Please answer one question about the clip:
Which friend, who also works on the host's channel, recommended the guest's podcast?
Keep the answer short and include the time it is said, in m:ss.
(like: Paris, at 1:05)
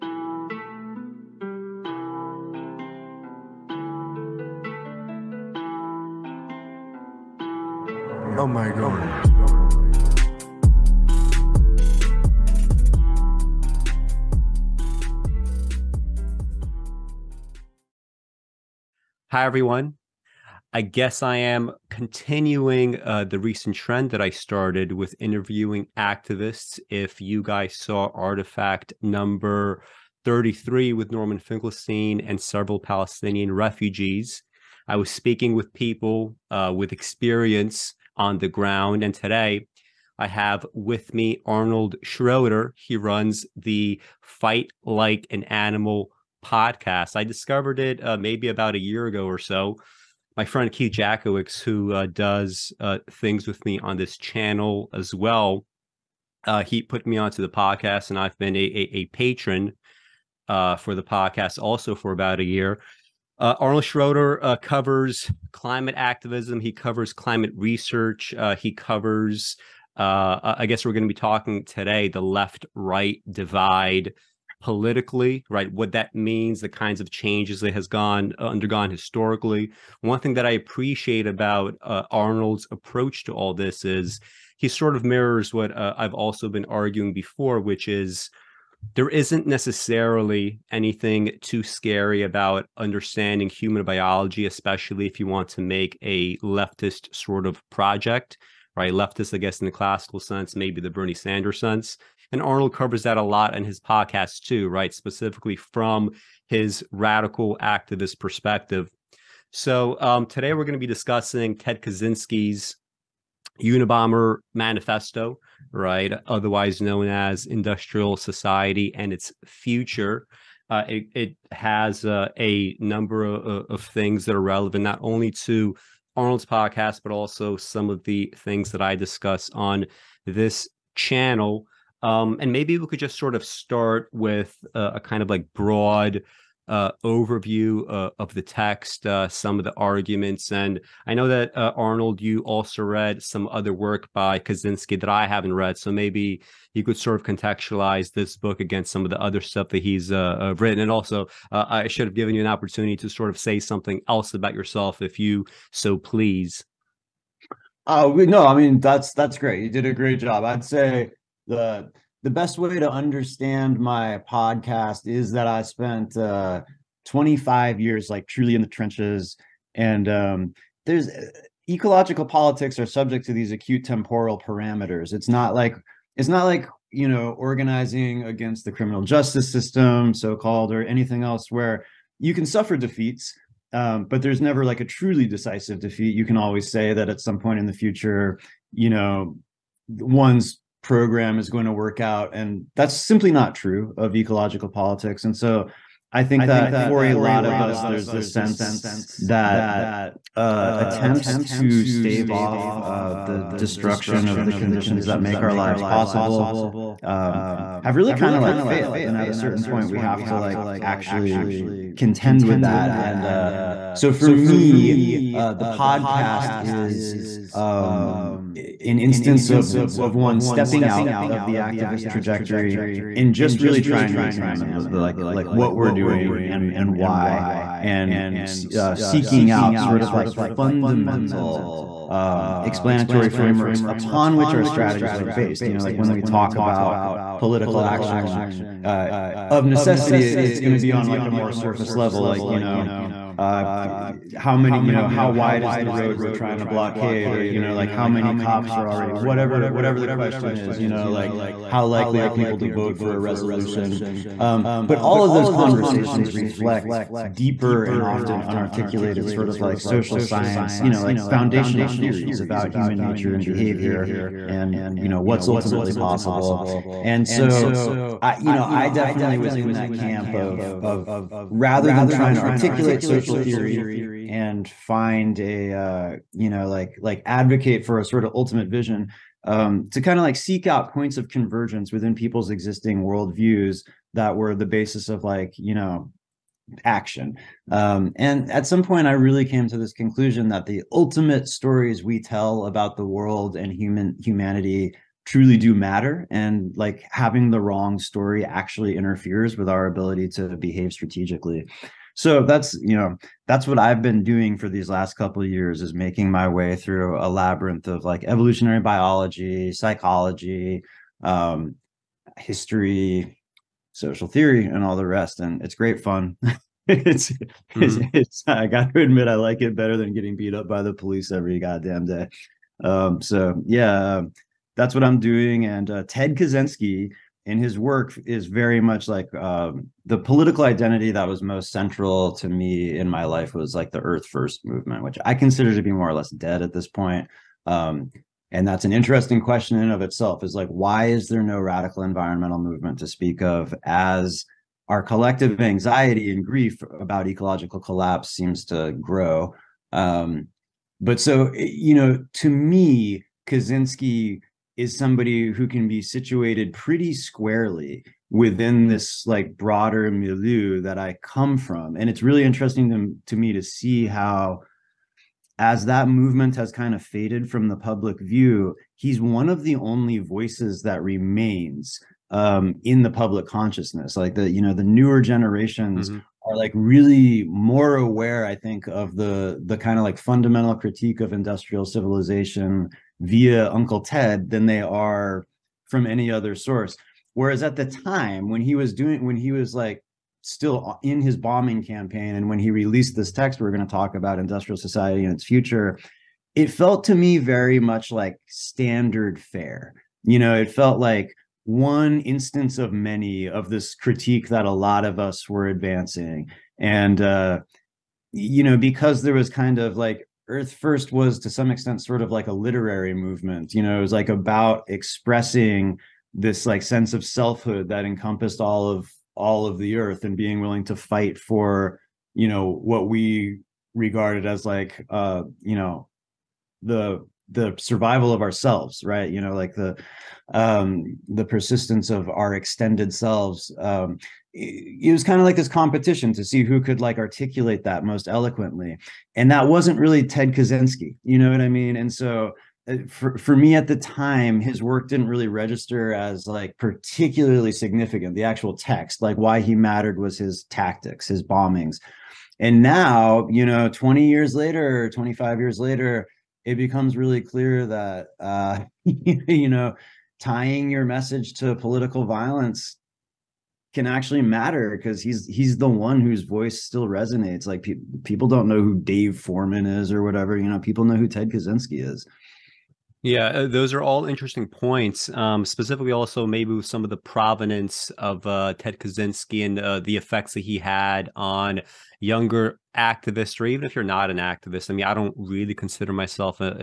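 Keith Jackowicz, at 0:50.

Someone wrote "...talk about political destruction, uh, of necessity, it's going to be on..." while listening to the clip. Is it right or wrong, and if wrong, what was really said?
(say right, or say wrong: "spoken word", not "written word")
wrong: "action", not "destruction".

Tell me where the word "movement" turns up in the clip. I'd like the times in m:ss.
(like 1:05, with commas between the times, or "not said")
5:34, 5:42, 6:06, 6:53.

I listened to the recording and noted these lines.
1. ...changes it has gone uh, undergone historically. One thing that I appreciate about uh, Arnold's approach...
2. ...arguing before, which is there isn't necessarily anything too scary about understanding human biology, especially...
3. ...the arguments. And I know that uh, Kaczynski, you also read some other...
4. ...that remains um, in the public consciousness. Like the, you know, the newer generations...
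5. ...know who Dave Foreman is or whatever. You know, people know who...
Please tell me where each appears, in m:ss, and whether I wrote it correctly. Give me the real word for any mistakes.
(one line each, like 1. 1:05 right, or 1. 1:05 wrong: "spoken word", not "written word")
1. 1:17 right
2. 1:26 right
3. 2:19 wrong: "Arnold", not "Kaczynski"
4. 6:10 right
5. 7:48 right.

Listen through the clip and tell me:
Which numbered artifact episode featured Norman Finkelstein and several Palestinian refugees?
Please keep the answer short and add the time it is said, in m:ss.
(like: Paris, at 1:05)
33, at 0:30.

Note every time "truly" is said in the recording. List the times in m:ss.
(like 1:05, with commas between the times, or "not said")
2:48, 3:04, 4:55.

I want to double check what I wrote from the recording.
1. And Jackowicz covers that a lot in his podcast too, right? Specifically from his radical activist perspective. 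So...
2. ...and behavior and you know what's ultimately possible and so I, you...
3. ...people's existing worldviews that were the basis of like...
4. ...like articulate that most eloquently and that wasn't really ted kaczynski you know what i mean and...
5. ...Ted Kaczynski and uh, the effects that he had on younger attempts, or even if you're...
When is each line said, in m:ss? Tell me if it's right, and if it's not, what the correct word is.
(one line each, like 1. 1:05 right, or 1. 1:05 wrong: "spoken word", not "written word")
1. 1:42 wrong: "Arnold", not "Jackowicz"
2. 4:23 right
3. 4:42 right
4. 7:16 right
5. 7:58 wrong: "activists", not "attempts".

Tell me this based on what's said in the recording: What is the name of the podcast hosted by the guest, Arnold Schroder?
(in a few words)
Fight Like an Animal.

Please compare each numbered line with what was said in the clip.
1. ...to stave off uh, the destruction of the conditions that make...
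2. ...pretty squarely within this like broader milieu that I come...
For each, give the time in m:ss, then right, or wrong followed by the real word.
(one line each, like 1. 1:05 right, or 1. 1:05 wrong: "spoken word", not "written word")
1. 3:21 right
2. 5:56 right.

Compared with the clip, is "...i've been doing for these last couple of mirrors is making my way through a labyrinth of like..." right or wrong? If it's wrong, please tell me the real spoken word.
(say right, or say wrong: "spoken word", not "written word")
wrong: "years", not "mirrors".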